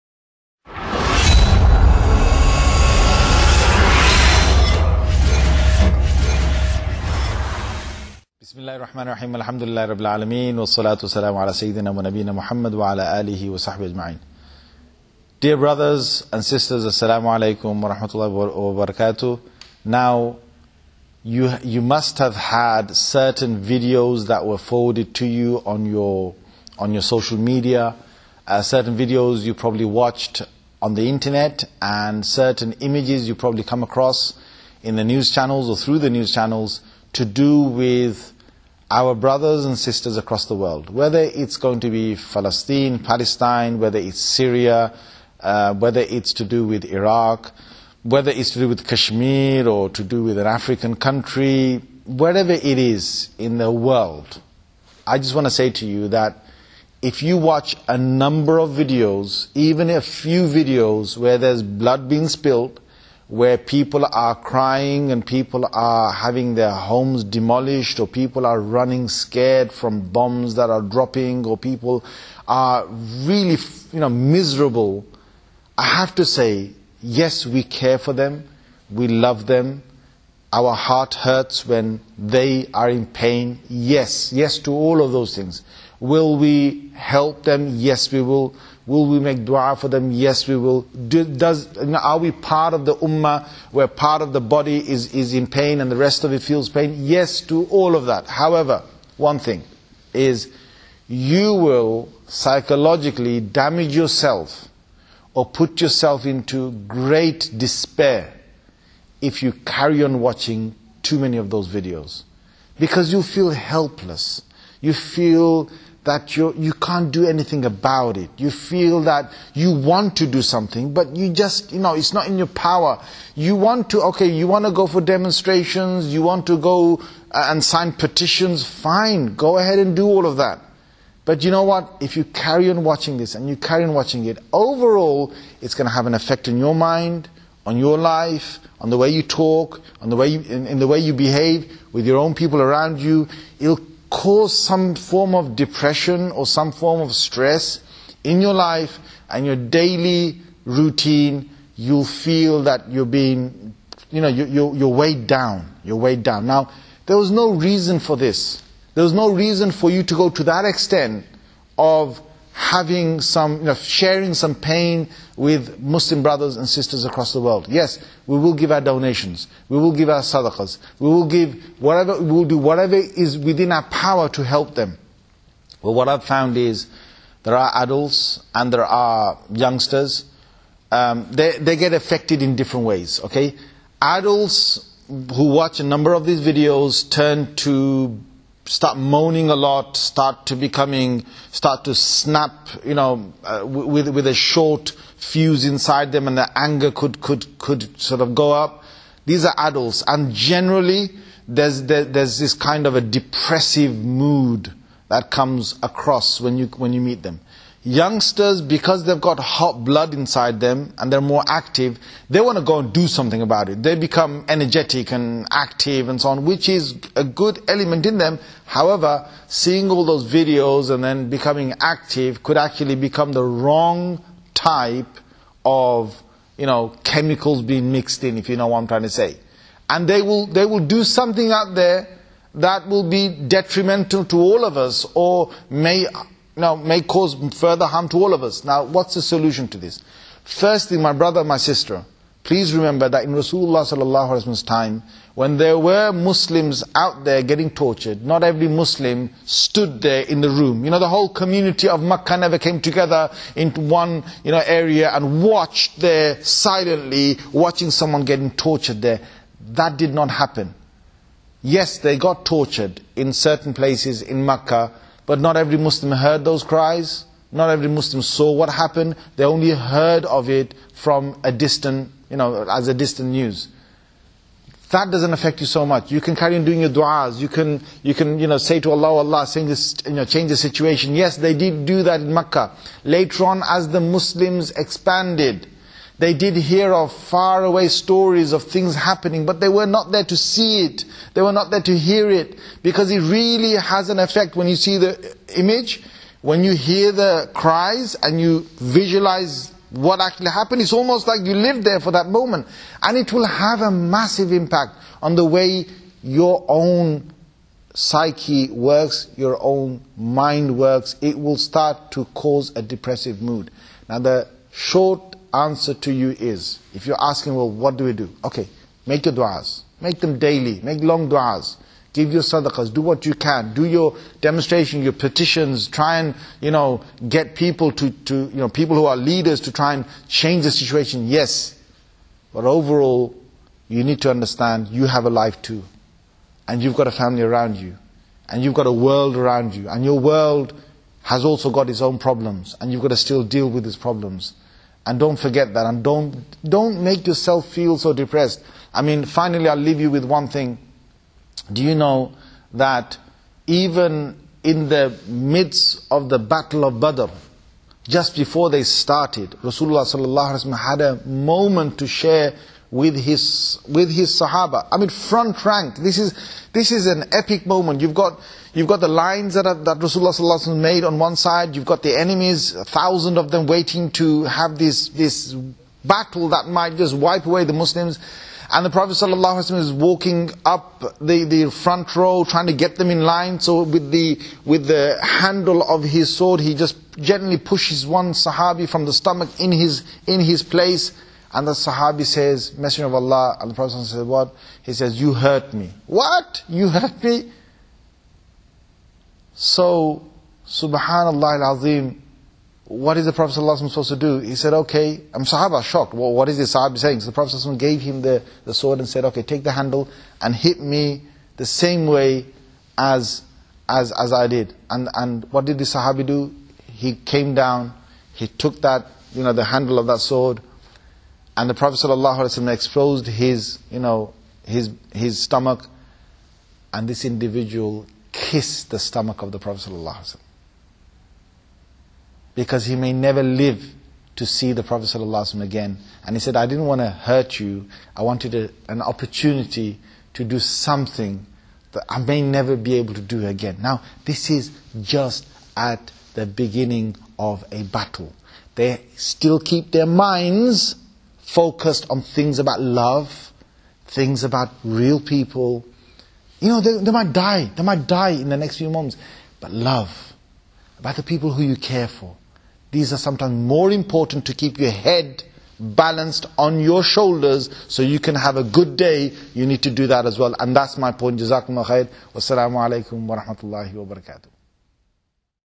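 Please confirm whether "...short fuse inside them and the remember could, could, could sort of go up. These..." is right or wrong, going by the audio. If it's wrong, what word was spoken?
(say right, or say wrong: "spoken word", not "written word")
wrong: "anger", not "remember".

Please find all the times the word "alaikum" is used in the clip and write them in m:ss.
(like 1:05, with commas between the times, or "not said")
0:17, 7:52.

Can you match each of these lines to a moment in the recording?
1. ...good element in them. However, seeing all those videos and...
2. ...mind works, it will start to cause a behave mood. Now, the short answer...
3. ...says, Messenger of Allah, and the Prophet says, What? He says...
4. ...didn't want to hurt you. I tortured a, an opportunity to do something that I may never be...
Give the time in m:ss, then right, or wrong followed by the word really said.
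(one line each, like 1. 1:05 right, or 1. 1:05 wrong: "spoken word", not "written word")
1. 3:37 right
2. 5:10 wrong: "depressive", not "behave"
3. 6:32 right
4. 7:16 wrong: "wanted", not "tortured".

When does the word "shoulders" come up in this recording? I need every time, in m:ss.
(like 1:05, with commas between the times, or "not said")
7:47.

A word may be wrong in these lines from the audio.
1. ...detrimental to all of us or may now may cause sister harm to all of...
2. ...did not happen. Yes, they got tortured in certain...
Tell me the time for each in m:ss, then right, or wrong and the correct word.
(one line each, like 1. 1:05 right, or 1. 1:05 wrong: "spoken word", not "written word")
1. 3:53 wrong: "further", not "sister"
2. 4:19 right.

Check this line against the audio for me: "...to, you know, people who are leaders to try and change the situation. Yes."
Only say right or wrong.
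right.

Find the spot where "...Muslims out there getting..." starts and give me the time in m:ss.
4:06.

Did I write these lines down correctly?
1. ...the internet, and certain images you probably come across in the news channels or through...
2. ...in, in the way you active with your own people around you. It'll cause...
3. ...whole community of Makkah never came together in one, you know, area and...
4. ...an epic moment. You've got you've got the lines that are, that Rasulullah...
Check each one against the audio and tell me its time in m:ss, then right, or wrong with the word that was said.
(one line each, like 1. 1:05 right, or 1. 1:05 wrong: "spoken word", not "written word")
1. 0:30 right
2. 2:20 wrong: "behave", not "active"
3. 4:11 right
4. 6:07 right.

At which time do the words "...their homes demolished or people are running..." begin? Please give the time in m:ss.
1:06.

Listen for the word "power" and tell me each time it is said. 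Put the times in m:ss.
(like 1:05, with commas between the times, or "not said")
2:02, 2:53.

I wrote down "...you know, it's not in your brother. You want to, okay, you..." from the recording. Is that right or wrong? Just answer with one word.
wrong.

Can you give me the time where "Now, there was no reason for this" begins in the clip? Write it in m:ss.
2:36.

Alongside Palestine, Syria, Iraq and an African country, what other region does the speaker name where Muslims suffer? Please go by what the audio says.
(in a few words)
Kashmir.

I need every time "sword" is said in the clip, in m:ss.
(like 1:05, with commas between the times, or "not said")
6:26, 6:48, 7:00.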